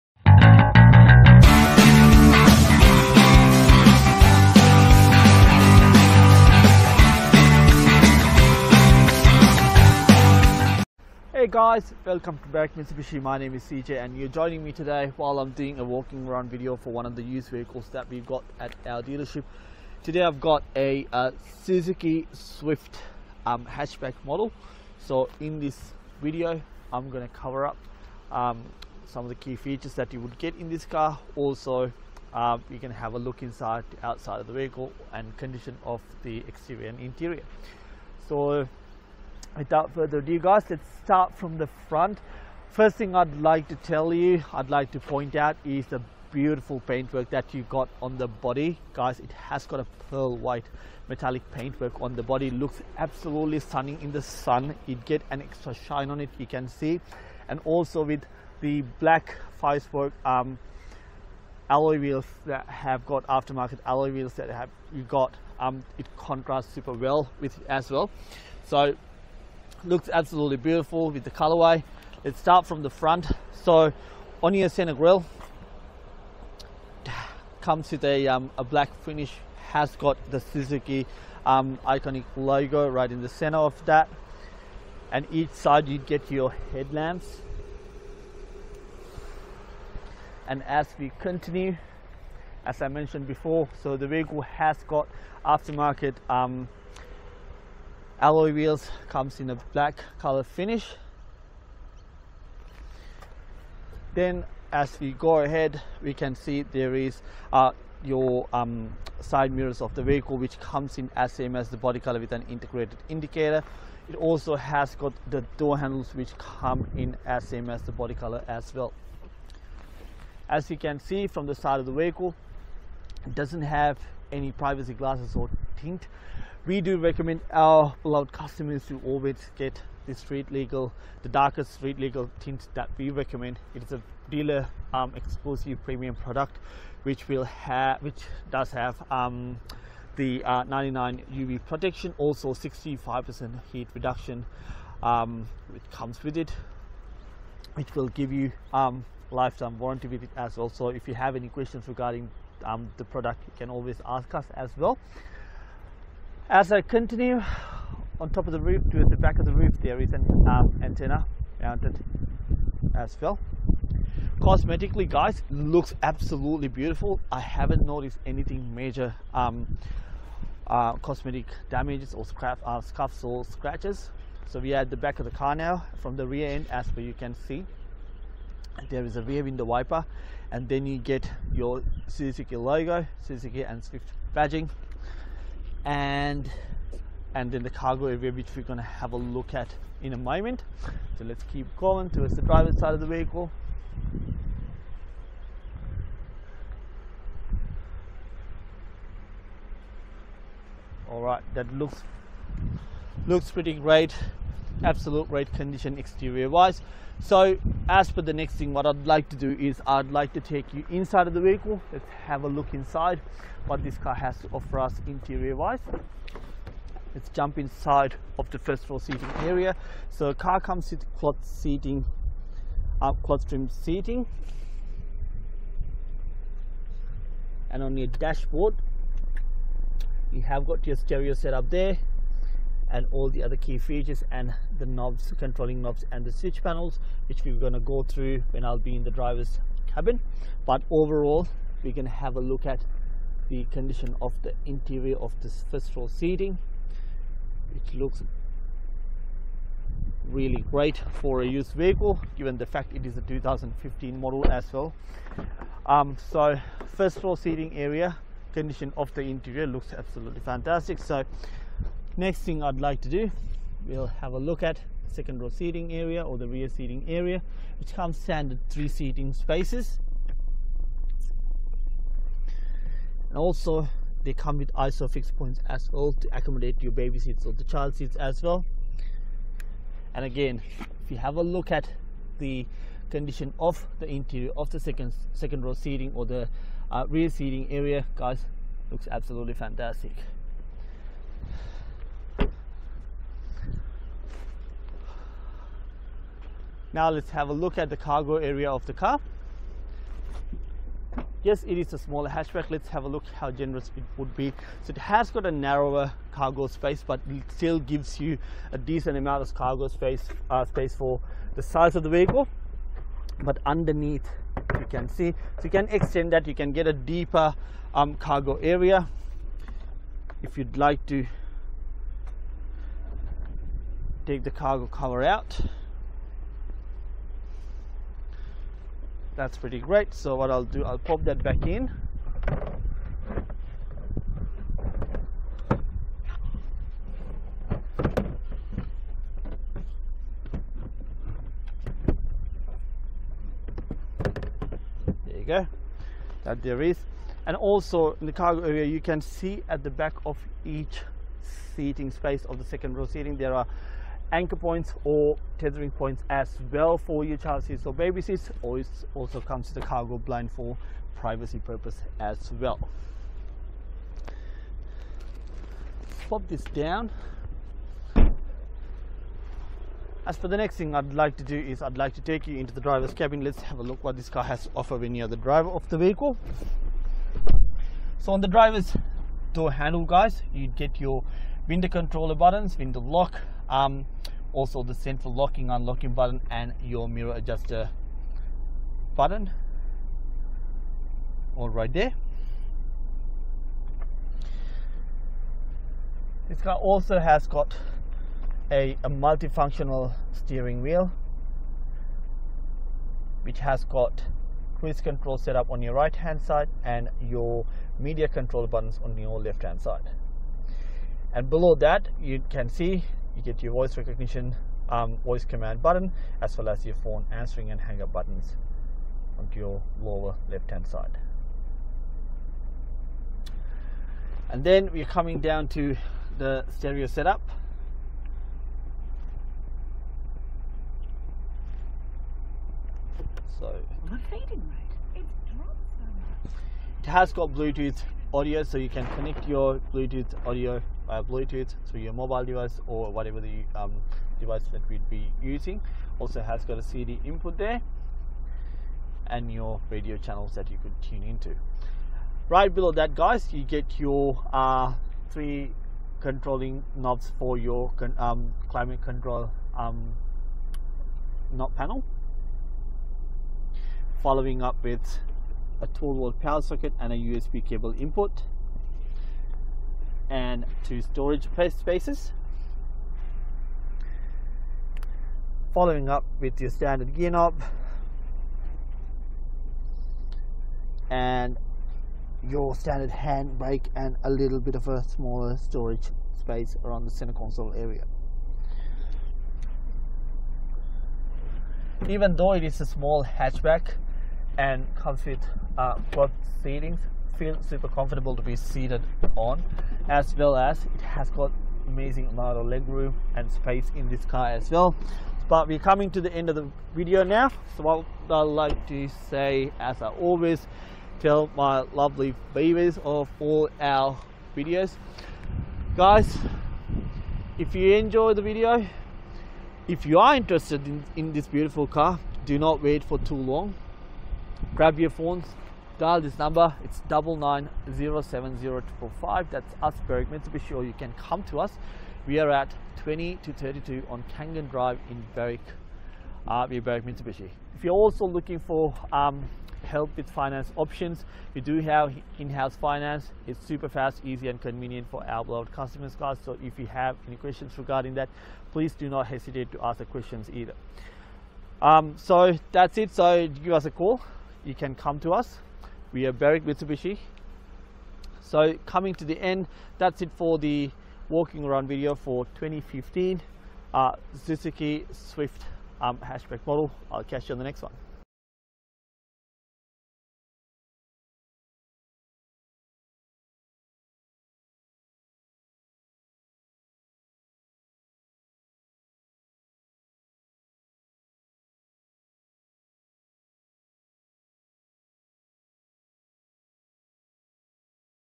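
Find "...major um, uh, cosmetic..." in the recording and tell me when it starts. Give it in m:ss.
2:48.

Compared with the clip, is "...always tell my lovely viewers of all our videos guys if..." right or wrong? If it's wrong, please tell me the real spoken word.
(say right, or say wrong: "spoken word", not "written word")
right.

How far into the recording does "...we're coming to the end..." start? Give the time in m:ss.
8:25.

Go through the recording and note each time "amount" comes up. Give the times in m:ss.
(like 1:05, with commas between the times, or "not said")
5:09, 8:22.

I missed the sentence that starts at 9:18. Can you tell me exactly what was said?
So coming to the end, that's it for the walking around video for 2015 uh, Suzuki Swift um, hatchback model.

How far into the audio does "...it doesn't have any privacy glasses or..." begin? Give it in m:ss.
2:03.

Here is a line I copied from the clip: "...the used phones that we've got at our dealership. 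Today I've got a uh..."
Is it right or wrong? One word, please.
wrong.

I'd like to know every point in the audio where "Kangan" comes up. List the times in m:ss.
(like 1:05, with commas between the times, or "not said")
8:54.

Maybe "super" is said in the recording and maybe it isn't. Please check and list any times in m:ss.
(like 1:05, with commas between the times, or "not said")
1:06, 8:17, 9:03.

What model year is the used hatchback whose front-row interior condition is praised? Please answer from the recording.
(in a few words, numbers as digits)
2015.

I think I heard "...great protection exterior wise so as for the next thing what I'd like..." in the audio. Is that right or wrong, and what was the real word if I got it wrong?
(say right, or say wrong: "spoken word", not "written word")
wrong: "condition", not "protection".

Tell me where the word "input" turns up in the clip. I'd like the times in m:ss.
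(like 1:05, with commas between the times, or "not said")
7:27, 7:47.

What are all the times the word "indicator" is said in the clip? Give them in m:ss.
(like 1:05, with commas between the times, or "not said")
1:53.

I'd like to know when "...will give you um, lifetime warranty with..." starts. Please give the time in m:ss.
2:27.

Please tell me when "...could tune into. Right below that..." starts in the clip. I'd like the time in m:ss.
7:30.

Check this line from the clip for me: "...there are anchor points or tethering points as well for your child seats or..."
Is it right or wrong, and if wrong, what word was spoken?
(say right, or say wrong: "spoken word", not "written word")
right.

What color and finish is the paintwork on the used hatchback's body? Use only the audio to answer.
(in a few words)
Pearl white metallic.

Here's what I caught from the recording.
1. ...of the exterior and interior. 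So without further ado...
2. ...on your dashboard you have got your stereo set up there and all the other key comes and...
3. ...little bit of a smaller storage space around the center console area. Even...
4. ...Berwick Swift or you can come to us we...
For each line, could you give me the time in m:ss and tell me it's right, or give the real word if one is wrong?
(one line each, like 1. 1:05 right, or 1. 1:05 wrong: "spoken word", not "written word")
1. 0:35 right
2. 3:47 wrong: "features", not "comes"
3. 8:04 right
4. 8:50 wrong: "Mitsubishi", not "Swift".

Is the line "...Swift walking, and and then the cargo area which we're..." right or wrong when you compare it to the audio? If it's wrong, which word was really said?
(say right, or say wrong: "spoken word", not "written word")
wrong: "badging", not "walking".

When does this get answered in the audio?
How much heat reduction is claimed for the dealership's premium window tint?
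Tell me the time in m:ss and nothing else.
2:22.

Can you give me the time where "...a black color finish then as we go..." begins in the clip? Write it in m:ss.
1:39.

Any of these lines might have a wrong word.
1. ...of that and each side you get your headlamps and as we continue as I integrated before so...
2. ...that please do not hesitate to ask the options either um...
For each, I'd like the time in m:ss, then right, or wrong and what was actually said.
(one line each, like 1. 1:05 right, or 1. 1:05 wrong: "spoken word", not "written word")
1. 1:23 wrong: "mentioned", not "integrated"
2. 9:08 wrong: "questions", not "options".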